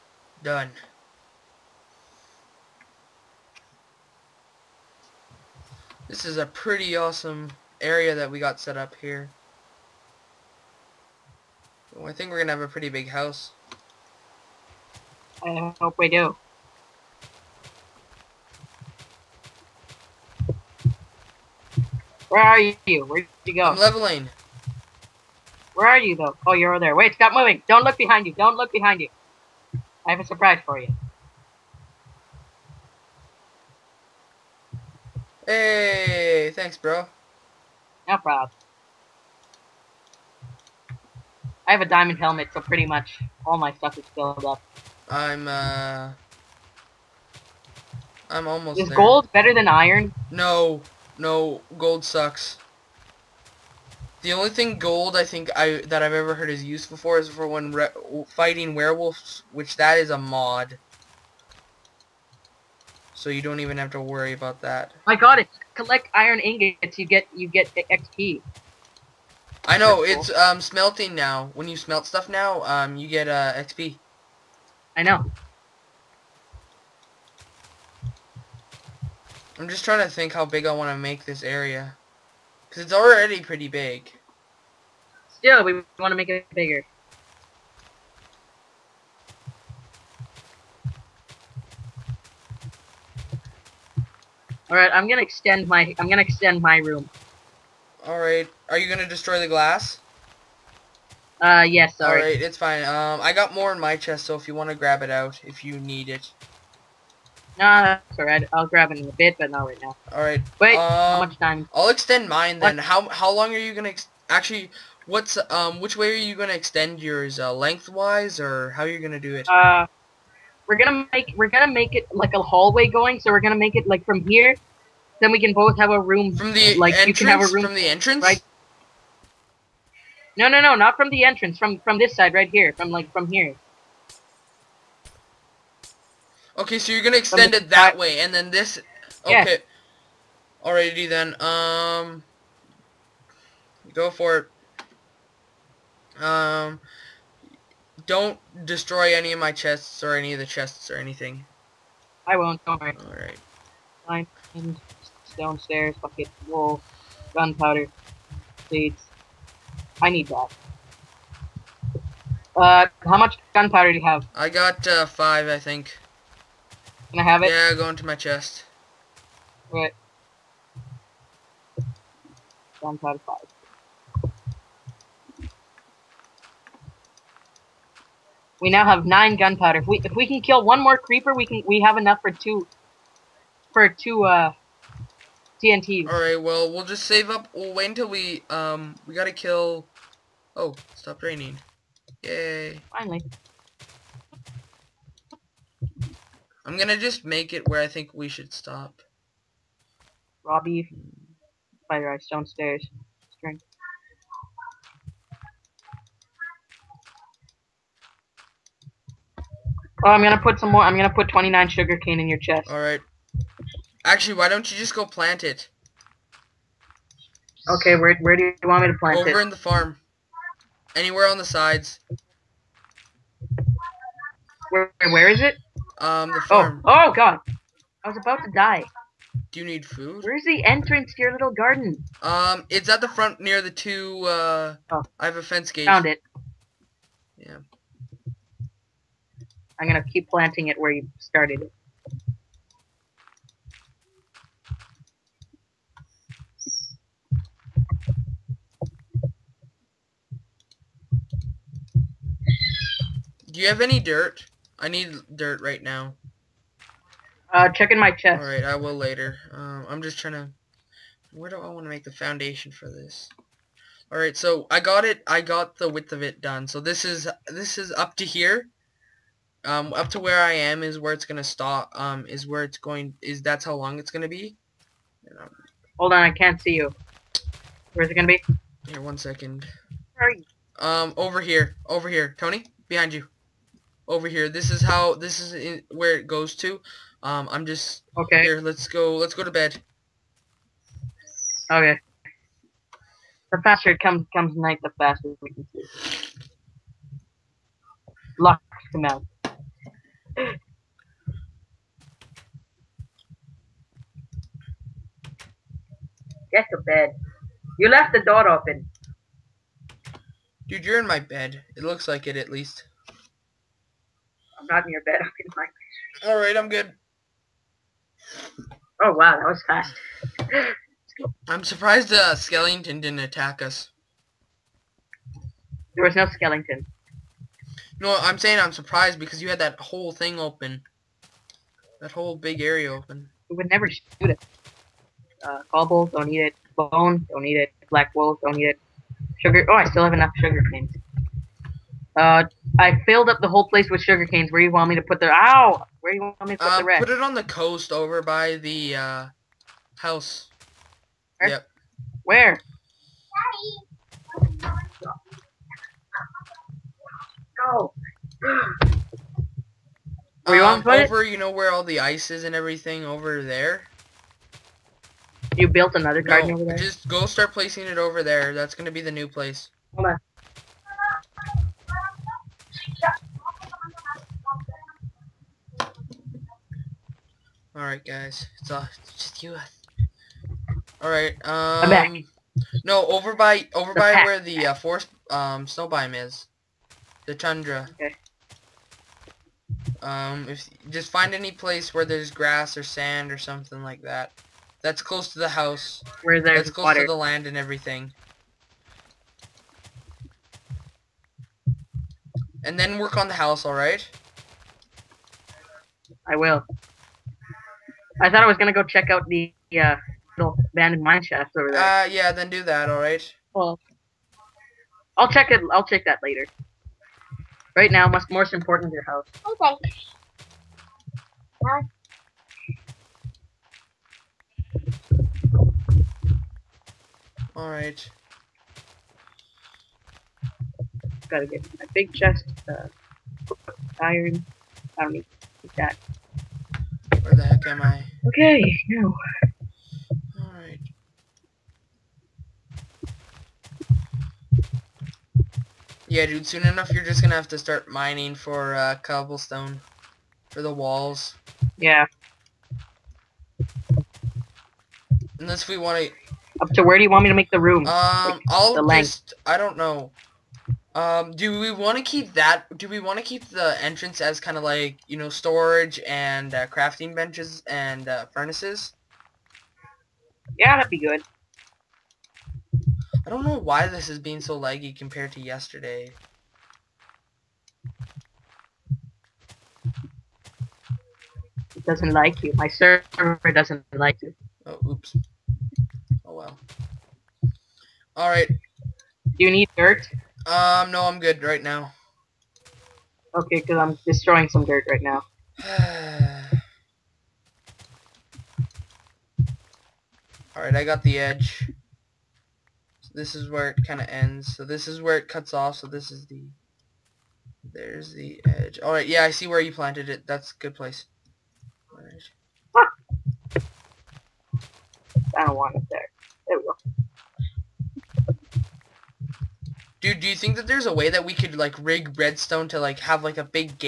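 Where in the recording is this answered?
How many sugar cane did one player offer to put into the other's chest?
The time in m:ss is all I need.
3:31.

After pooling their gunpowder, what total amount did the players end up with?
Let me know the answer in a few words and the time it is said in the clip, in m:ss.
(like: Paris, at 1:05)
9, at 2:59.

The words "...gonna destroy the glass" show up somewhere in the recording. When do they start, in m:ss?
1:38.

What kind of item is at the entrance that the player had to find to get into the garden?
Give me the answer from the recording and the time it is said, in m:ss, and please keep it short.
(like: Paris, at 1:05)
Fence gate, at 3:55.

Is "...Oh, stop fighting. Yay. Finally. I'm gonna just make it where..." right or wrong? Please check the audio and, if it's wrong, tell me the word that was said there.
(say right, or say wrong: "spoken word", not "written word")
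wrong: "raining", not "fighting".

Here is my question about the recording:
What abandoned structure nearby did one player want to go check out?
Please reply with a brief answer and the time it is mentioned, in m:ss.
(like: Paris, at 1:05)
Mine shaft, at 6:50.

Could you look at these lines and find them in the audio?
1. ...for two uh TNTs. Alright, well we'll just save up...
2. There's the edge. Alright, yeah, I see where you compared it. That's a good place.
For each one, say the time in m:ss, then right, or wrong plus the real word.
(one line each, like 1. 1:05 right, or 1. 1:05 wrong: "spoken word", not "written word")
1. 3:03 right
2. 8:27 wrong: "planted", not "compared".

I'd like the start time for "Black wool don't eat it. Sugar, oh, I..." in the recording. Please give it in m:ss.
5:37.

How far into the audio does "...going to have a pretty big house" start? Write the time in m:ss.
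0:12.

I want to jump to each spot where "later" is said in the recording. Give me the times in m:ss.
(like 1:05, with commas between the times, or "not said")
4:18, 6:56.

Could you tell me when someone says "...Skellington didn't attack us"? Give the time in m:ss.
5:22.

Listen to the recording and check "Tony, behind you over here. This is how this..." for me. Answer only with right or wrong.
right.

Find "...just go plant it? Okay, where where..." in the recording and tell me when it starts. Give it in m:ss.
3:34.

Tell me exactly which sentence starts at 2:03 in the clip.
So we're gonna make it like from here.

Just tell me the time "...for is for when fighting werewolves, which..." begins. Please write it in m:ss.
0:56.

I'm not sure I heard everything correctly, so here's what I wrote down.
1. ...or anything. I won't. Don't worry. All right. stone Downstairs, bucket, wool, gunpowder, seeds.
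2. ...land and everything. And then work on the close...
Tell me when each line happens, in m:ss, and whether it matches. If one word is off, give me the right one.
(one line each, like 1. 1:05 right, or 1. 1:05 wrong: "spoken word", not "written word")
1. 2:30 right
2. 6:37 wrong: "house", not "close".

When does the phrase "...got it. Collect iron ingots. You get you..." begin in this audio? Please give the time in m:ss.
1:05.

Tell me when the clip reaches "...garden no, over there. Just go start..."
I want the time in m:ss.
6:06.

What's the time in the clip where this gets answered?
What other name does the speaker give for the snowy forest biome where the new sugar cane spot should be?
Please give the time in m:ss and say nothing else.
6:27.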